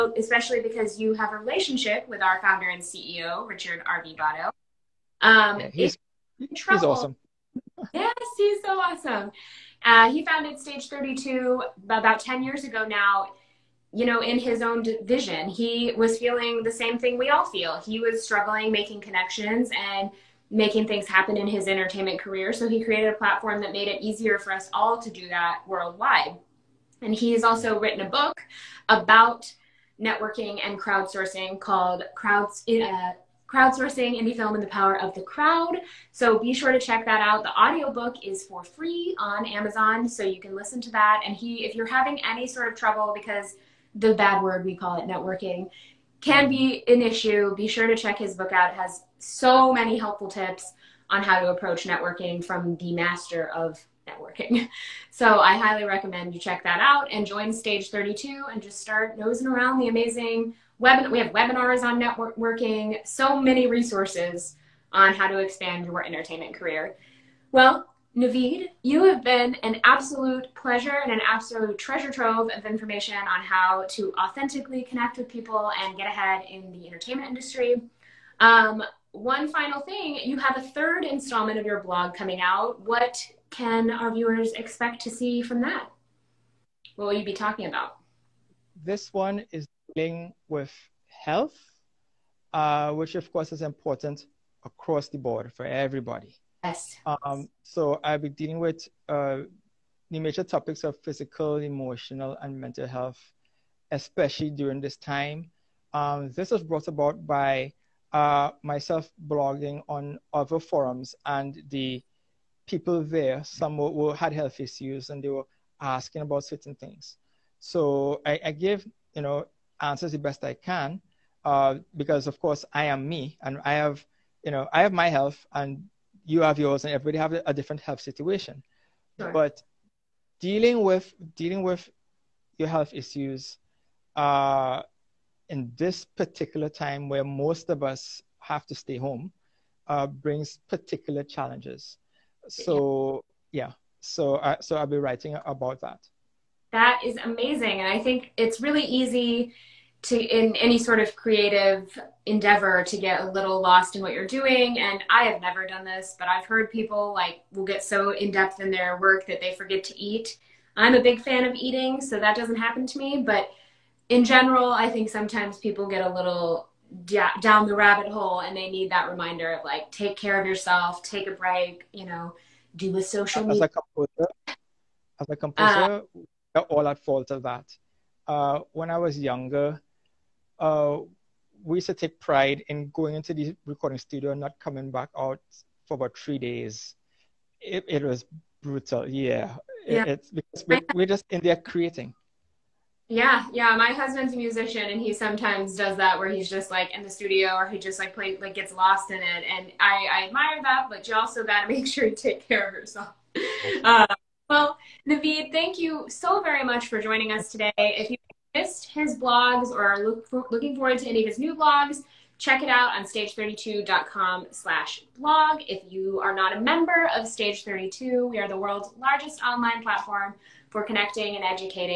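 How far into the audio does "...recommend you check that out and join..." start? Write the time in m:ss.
0:55.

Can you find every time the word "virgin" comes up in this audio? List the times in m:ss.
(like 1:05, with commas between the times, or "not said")
not said.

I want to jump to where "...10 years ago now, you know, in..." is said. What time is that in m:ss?
0:12.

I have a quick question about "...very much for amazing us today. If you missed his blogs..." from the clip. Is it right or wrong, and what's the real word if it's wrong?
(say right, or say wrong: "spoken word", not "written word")
wrong: "joining", not "amazing".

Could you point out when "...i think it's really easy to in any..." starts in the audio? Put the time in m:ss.
2:27.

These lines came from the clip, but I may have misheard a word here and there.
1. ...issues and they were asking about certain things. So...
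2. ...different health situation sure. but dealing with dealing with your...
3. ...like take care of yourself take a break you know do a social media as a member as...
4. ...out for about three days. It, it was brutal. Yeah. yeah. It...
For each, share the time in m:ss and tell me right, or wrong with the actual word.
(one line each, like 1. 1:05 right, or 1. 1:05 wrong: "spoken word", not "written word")
1. 1:54 right
2. 2:07 right
3. 2:49 wrong: "composer", not "member"
4. 3:05 right.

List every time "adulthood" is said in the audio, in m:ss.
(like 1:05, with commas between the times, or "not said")
not said.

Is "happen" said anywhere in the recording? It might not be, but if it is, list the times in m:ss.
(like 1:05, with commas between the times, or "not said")
0:21, 2:42.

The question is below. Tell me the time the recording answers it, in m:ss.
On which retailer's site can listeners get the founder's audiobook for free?
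0:39.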